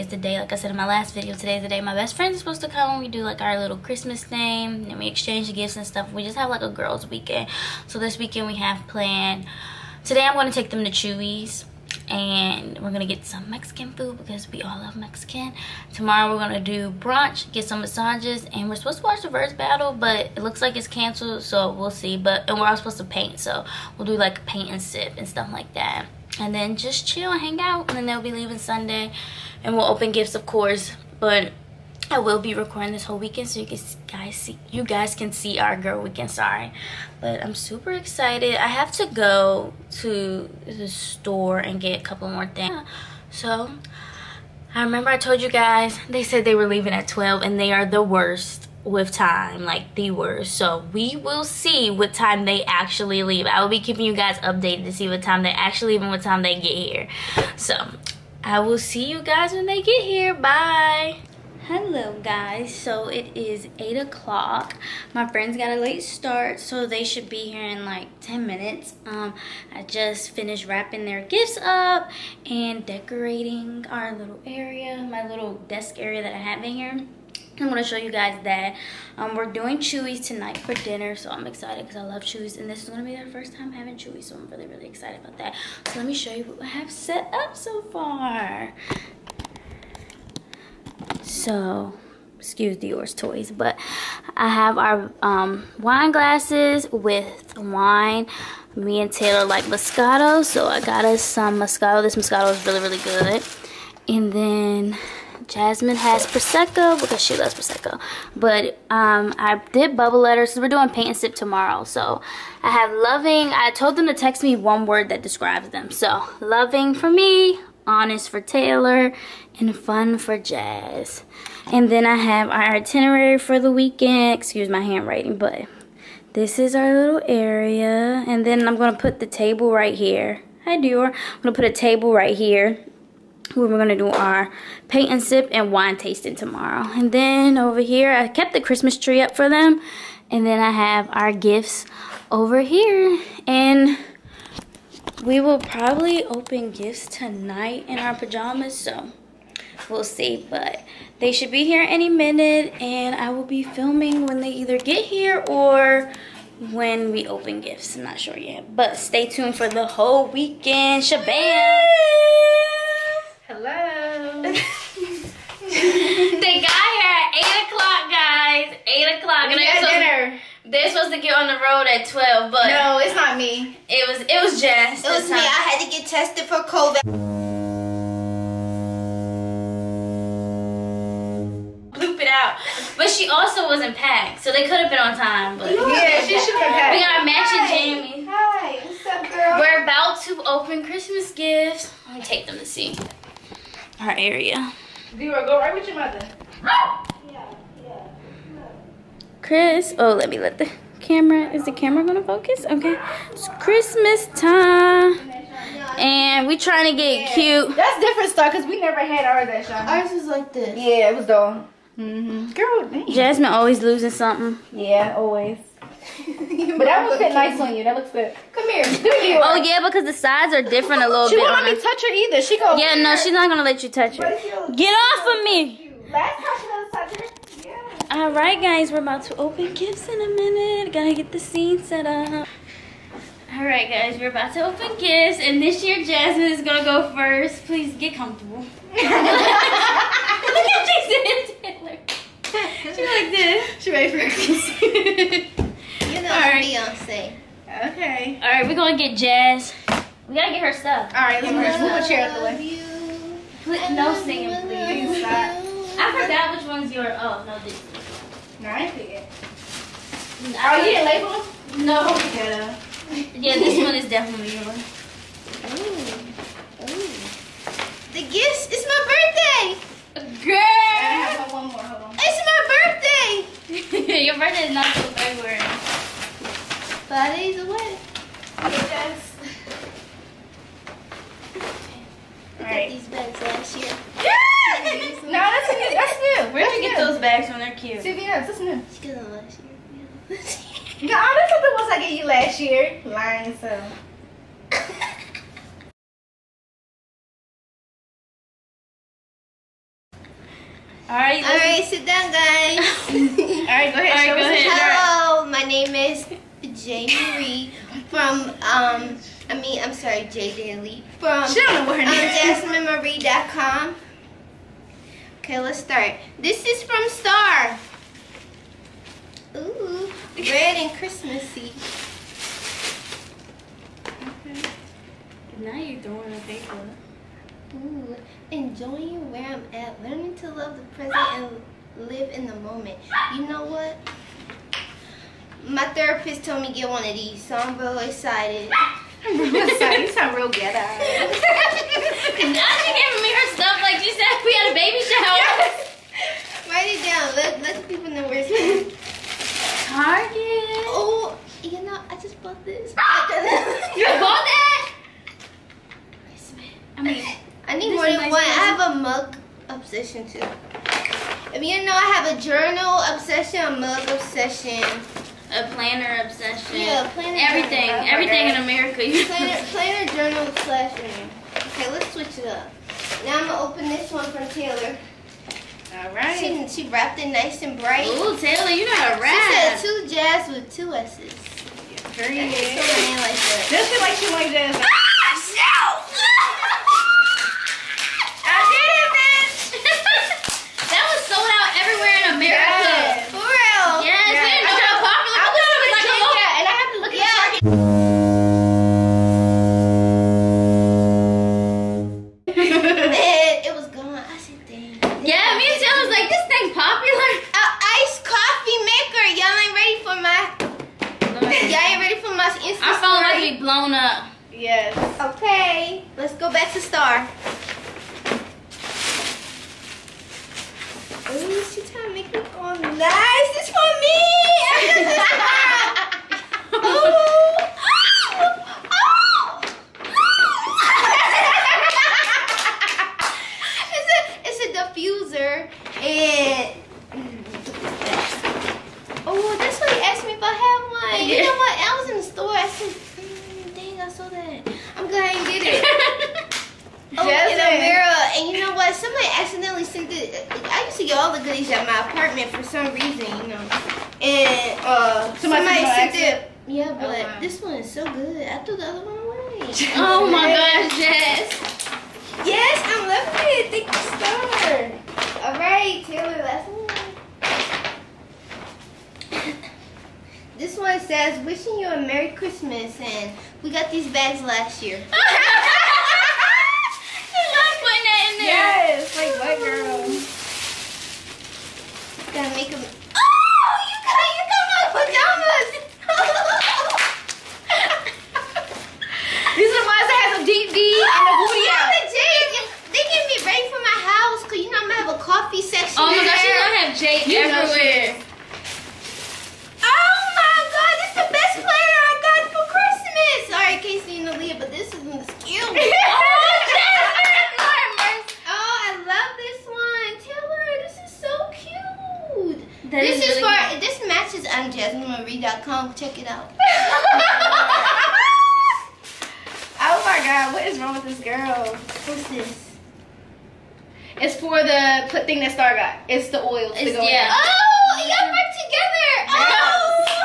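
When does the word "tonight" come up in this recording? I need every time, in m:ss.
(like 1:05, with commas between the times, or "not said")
1:20, 2:27.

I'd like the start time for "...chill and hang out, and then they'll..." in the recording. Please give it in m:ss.
0:27.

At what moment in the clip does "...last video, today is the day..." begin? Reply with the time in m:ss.
0:00.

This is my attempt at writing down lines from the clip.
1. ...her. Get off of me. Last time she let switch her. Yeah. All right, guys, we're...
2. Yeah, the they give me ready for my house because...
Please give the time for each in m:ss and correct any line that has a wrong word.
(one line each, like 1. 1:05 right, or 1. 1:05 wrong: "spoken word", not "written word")
1. 3:44 wrong: "touch", not "switch"
2. 8:12 right.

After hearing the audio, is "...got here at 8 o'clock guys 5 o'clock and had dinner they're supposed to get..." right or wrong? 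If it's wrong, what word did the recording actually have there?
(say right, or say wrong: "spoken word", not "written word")
wrong: "8", not "5".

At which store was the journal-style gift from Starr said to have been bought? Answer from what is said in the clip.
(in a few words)
Target.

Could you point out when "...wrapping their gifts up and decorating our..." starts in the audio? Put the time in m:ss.
1:10.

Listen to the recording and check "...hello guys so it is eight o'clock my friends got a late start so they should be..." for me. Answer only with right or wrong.
right.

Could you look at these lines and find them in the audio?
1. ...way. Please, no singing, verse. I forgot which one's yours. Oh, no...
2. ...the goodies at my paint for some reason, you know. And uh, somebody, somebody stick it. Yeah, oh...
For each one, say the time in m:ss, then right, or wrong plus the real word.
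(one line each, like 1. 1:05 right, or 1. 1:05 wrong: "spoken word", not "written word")
1. 4:12 wrong: "please", not "verse"
2. 7:31 wrong: "apartment", not "paint".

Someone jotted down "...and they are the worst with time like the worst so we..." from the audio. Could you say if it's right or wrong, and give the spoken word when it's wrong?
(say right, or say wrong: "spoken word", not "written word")
right.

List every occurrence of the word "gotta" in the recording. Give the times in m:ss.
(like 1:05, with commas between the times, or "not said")
3:50, 4:10.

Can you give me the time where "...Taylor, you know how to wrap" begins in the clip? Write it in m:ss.
6:18.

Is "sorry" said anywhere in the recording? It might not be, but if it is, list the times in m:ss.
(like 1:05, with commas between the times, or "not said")
0:36, 5:09, 8:23.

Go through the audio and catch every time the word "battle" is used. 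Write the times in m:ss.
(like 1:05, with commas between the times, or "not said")
0:19.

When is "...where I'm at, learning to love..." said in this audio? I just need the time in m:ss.
5:29.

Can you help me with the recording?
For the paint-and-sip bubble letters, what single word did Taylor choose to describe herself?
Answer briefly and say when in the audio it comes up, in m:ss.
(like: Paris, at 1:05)
honest, at 1:57.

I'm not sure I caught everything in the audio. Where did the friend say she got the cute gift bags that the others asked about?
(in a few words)
CVS.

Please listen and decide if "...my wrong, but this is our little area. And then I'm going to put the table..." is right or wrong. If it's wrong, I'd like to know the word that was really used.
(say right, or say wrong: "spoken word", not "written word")
wrong: "handwriting", not "wrong".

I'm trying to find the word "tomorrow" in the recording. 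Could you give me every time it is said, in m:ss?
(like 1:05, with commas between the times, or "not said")
0:15, 1:51, 2:16.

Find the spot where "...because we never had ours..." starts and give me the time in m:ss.
3:28.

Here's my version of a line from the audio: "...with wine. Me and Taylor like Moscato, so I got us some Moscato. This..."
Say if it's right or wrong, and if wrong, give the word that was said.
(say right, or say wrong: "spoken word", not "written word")
right.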